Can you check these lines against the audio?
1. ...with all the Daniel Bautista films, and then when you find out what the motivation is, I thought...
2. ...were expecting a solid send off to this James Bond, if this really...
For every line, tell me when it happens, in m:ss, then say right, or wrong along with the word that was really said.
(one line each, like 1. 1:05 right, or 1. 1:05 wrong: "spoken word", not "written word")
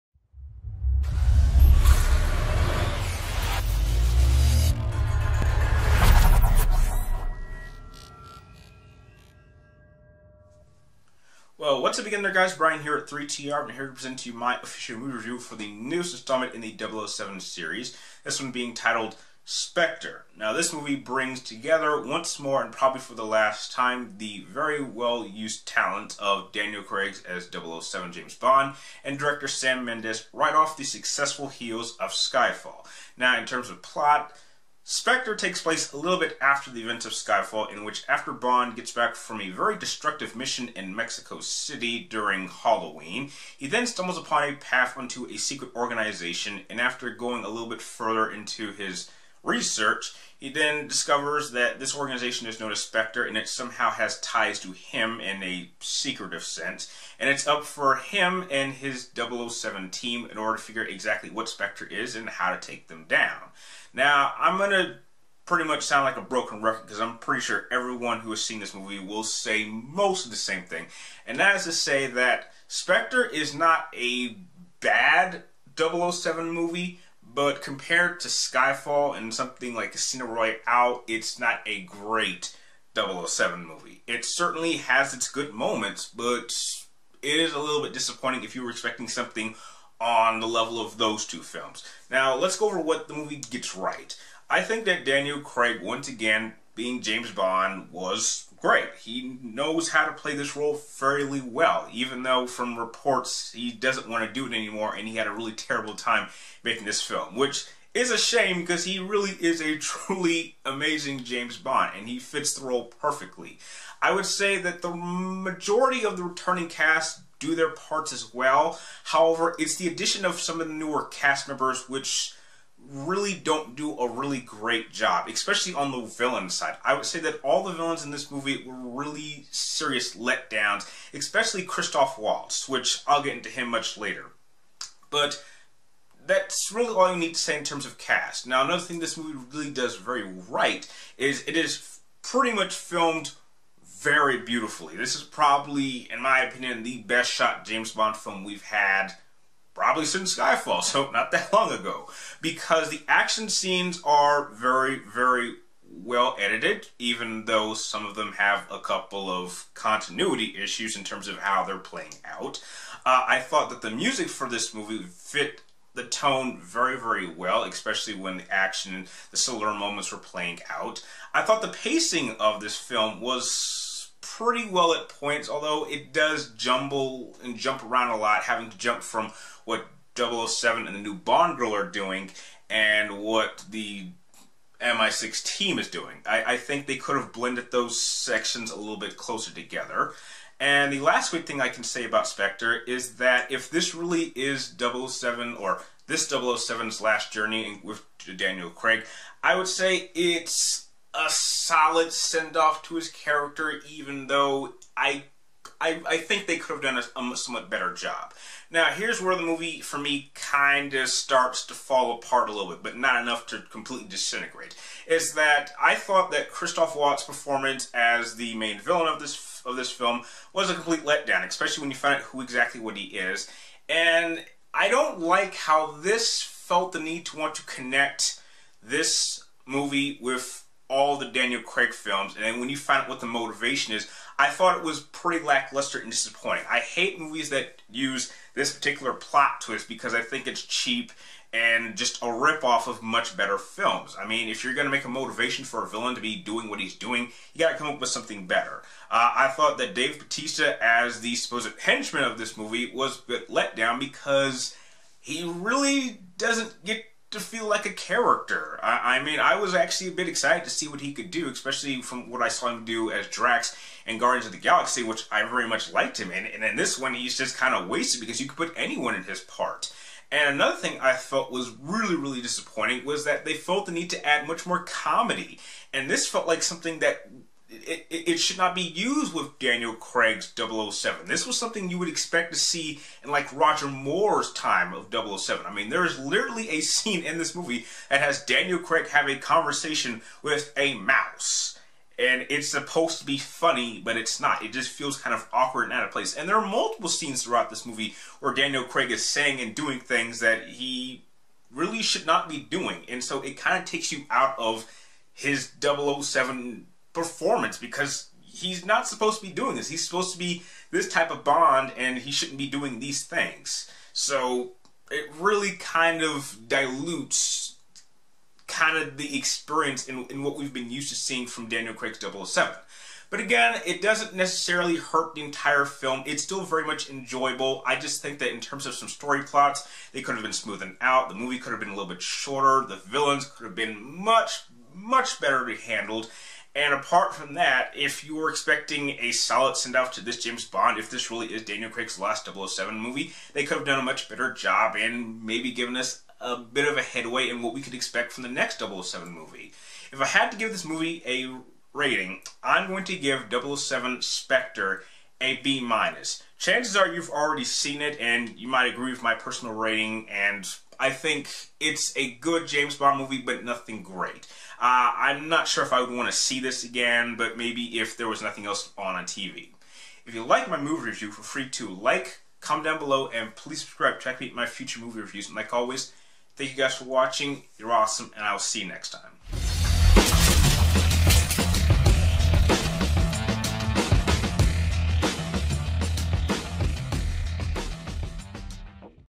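1. 3:50 wrong: "Craig", not "Bautista"
2. 5:38 right.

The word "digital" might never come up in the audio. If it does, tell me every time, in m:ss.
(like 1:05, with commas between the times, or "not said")
not said.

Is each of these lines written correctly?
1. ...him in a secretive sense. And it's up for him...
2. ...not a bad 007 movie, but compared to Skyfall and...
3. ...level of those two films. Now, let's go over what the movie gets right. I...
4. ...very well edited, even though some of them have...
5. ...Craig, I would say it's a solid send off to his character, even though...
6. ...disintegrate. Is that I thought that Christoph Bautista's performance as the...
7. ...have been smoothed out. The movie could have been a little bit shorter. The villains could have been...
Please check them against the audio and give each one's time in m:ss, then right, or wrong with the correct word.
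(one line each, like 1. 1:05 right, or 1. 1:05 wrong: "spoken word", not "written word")
1. 0:54 right
2. 1:13 right
3. 1:30 right
4. 2:34 right
5. 3:18 right
6. 3:34 wrong: "Waltz", not "Bautista"
7. 5:30 right.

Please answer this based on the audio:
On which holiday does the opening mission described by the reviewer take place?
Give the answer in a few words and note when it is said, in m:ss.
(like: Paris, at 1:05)
Halloween, at 0:42.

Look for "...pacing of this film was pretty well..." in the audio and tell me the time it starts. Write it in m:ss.
2:51.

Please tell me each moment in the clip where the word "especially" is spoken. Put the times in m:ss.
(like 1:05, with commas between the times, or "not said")
2:05, 2:11, 2:47, 3:41, 4:21.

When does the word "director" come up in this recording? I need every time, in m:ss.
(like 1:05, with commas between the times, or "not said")
0:29.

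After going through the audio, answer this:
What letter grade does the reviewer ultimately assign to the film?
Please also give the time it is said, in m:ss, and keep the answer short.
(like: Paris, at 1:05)
B minus, at 5:55.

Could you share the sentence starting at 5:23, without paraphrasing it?
But again, it doesn't necessarily hurt the entire film.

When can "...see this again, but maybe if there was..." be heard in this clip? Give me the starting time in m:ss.
6:06.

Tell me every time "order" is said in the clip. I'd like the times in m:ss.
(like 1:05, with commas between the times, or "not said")
1:00.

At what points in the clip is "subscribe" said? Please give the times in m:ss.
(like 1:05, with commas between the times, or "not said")
6:13.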